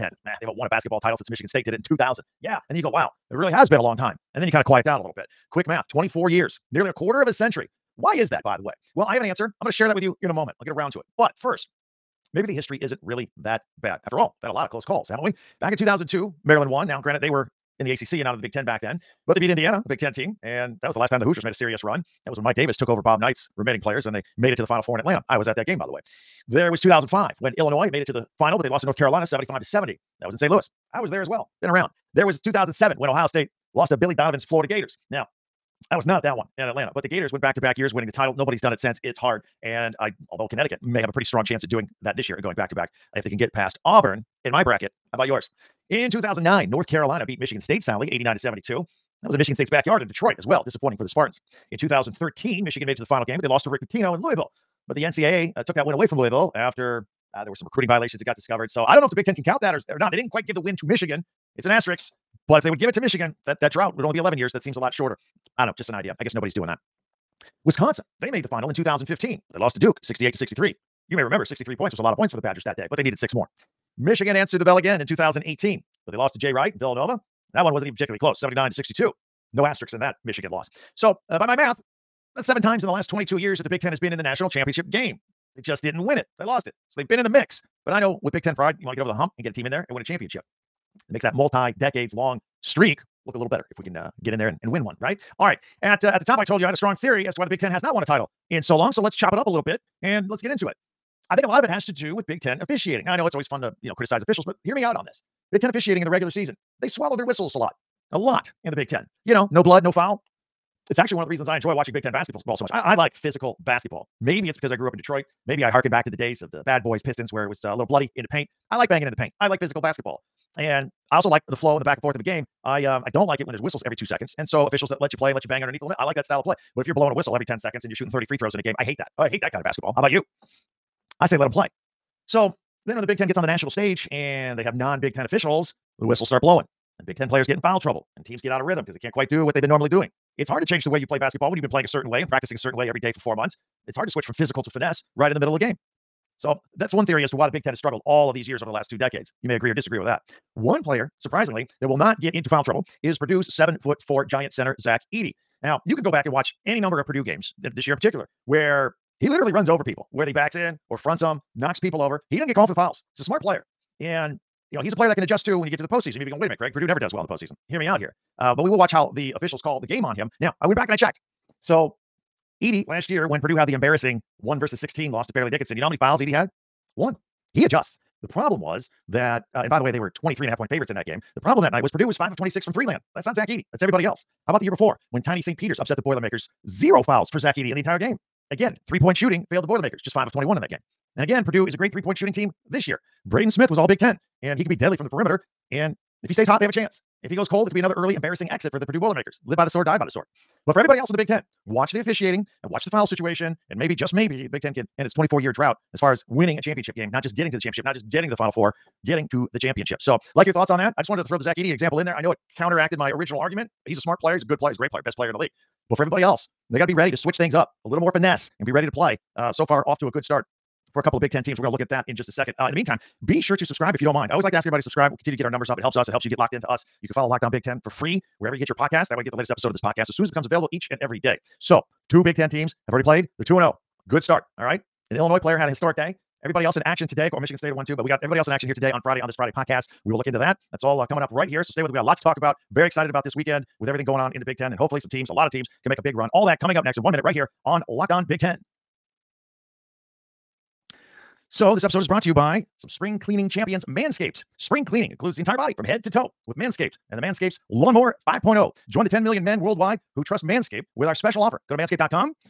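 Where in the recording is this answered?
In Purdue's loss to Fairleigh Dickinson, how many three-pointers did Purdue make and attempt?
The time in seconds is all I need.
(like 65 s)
182 s.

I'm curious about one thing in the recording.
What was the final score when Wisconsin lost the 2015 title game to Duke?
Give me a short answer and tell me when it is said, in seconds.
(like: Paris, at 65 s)
68 to 63, at 70 s.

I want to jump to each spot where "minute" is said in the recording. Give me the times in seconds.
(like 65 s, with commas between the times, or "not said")
166 s, 247 s.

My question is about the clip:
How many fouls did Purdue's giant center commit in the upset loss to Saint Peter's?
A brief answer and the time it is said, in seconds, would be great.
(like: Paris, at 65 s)
Zero, at 186 s.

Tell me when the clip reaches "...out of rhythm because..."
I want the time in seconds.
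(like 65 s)
138 s.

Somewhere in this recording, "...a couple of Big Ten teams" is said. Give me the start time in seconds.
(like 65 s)
220 s.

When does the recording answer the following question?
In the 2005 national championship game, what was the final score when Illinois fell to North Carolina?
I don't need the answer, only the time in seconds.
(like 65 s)
29 s.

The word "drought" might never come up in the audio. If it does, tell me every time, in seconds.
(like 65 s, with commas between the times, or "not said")
63 s, 205 s.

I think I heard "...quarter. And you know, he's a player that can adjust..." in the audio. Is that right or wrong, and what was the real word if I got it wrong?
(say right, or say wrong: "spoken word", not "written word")
wrong: "player", not "quarter".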